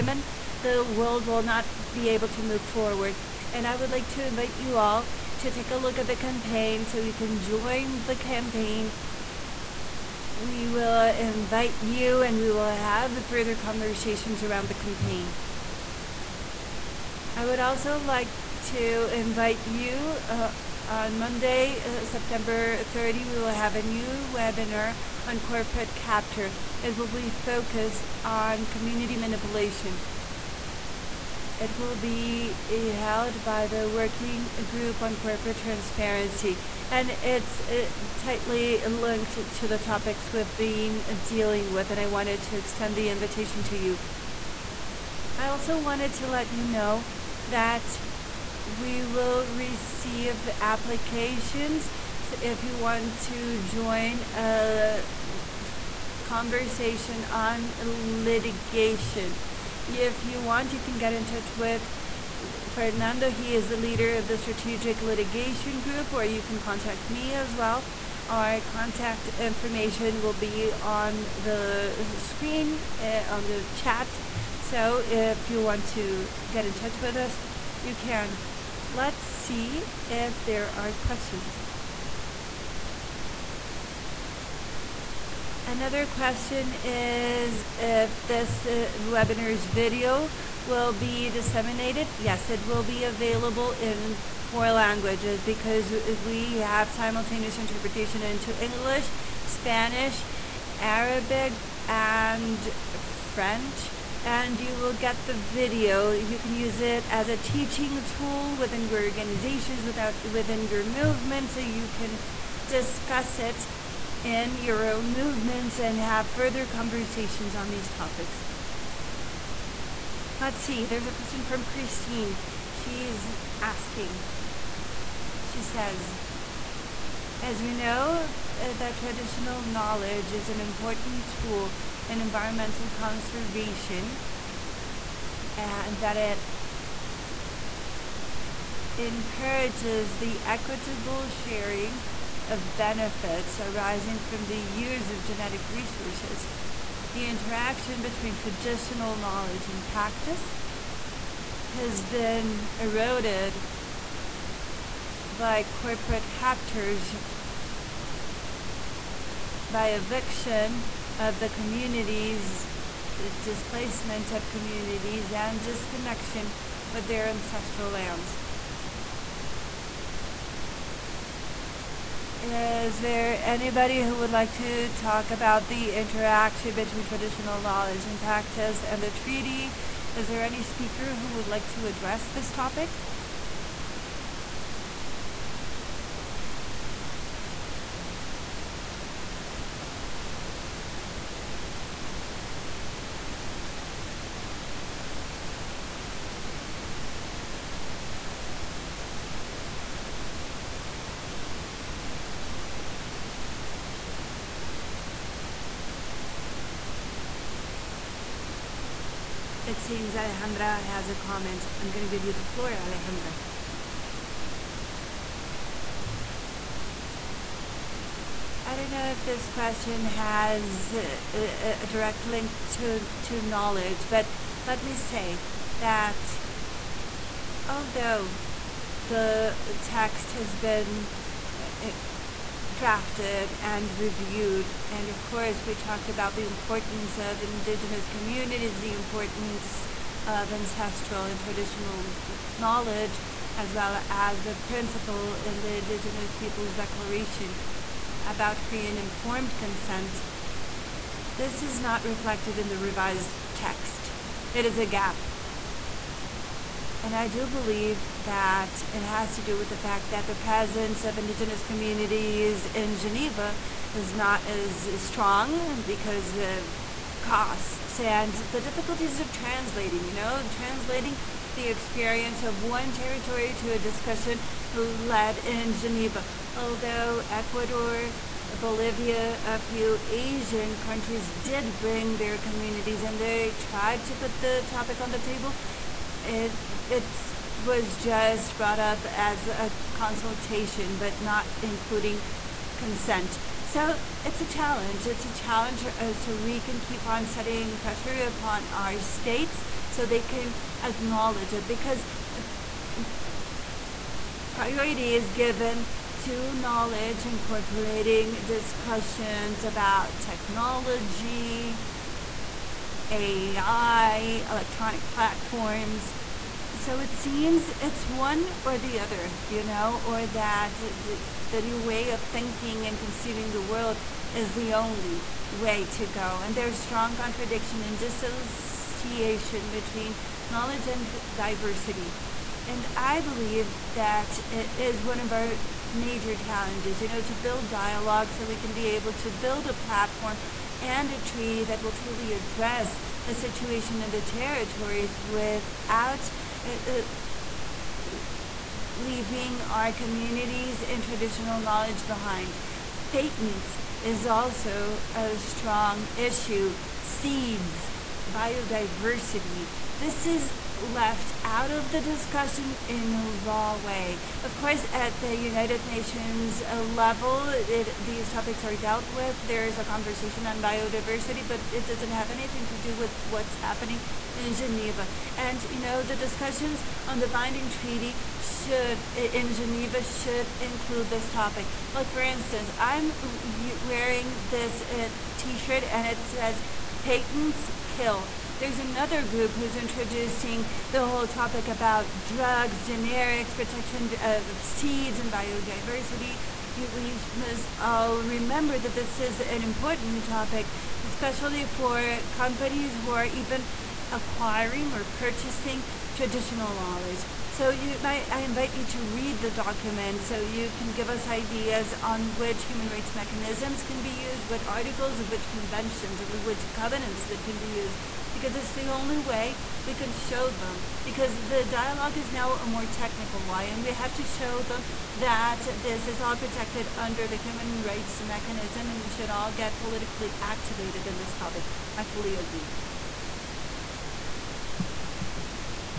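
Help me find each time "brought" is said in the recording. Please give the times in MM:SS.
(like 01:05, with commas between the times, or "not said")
04:48.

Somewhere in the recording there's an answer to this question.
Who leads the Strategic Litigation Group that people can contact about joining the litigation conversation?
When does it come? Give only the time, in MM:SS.
01:02.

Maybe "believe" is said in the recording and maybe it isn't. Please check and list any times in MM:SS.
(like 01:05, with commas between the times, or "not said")
04:17, 05:33.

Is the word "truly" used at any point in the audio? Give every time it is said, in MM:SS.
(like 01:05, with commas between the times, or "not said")
05:41.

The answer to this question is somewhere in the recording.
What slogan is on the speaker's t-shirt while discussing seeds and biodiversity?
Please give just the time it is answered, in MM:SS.
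06:27.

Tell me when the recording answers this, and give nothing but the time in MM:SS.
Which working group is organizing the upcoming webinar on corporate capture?
00:33.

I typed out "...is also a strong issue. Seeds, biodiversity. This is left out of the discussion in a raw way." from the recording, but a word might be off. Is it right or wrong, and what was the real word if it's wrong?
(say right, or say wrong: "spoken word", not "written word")
right.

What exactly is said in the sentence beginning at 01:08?
Our contact information will be on the screen, uh, on the chat.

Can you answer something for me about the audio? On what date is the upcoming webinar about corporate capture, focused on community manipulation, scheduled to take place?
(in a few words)
Monday, September 30.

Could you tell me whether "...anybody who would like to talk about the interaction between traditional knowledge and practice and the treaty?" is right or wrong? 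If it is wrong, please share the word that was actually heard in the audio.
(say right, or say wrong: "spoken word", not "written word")
right.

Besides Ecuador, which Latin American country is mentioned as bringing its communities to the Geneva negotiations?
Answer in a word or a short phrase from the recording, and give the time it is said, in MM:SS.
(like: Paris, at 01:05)
Bolivia, at 04:38.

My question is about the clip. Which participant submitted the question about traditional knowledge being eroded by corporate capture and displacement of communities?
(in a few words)
Christine.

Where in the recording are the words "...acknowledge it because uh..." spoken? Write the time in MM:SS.
05:00.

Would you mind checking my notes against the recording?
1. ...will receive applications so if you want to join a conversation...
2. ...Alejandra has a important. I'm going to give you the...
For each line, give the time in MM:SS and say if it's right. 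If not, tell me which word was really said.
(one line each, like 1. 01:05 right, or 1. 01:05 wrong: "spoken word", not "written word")
1. 00:49 right
2. 03:30 wrong: "comment", not "important".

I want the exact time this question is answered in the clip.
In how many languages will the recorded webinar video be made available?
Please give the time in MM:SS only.
01:34.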